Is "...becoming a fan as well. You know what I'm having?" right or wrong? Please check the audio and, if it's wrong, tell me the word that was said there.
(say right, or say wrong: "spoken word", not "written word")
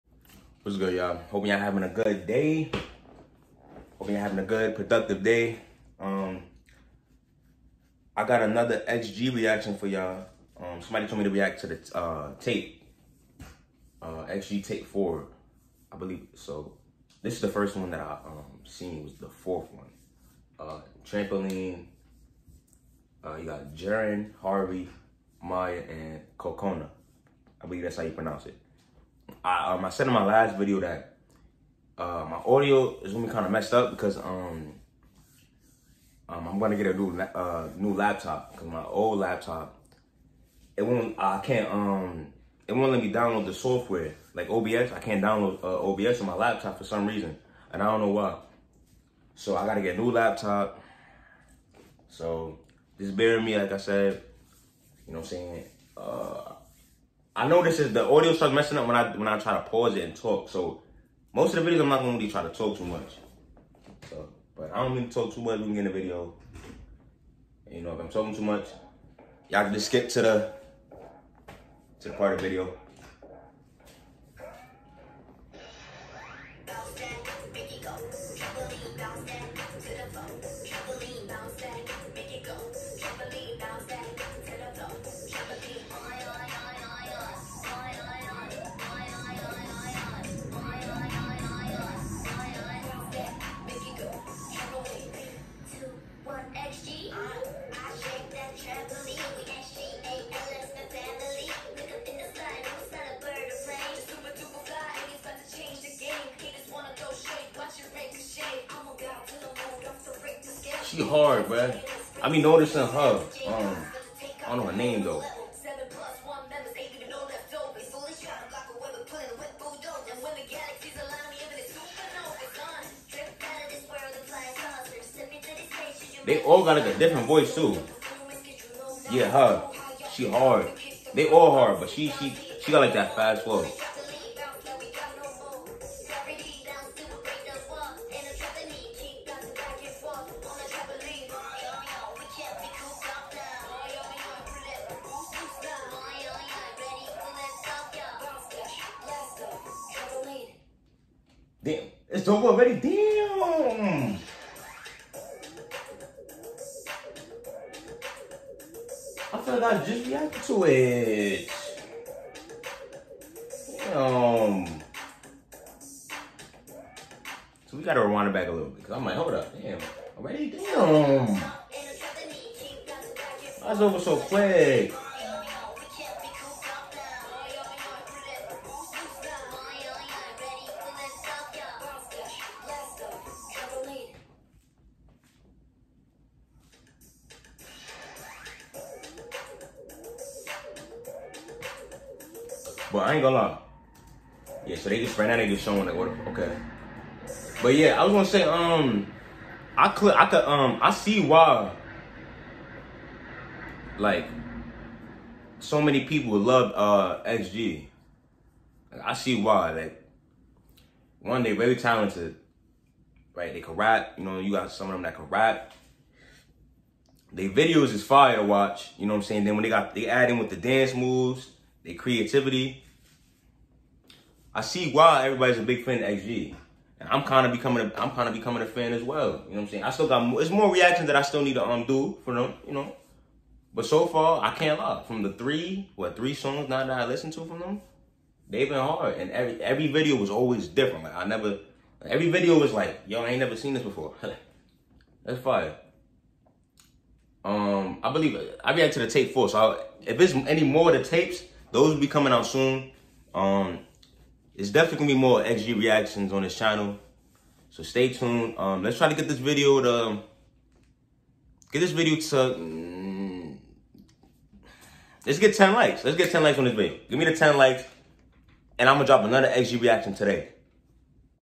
wrong: "saying", not "having".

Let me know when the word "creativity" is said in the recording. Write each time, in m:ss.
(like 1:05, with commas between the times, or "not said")
3:41.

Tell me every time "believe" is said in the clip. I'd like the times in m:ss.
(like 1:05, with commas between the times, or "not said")
0:15, 0:27, 4:08.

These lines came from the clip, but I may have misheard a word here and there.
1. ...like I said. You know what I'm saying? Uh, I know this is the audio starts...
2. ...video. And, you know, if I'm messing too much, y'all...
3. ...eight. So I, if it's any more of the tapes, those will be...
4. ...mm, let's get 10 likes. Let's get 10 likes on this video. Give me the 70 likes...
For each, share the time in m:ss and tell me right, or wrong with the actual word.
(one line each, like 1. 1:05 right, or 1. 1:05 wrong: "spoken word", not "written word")
1. 0:53 right
2. 1:05 wrong: "talking", not "messing"
3. 4:09 wrong: "four", not "eight"
4. 4:22 wrong: "10", not "70".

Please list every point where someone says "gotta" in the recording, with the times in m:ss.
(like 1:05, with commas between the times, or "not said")
0:49, 2:47.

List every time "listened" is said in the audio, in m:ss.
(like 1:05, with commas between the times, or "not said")
3:57.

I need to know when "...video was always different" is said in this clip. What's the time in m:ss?
3:59.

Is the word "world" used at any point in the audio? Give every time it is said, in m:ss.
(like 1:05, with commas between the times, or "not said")
not said.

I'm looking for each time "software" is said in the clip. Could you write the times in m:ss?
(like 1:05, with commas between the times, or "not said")
0:43.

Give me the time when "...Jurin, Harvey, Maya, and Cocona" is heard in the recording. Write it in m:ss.
0:23.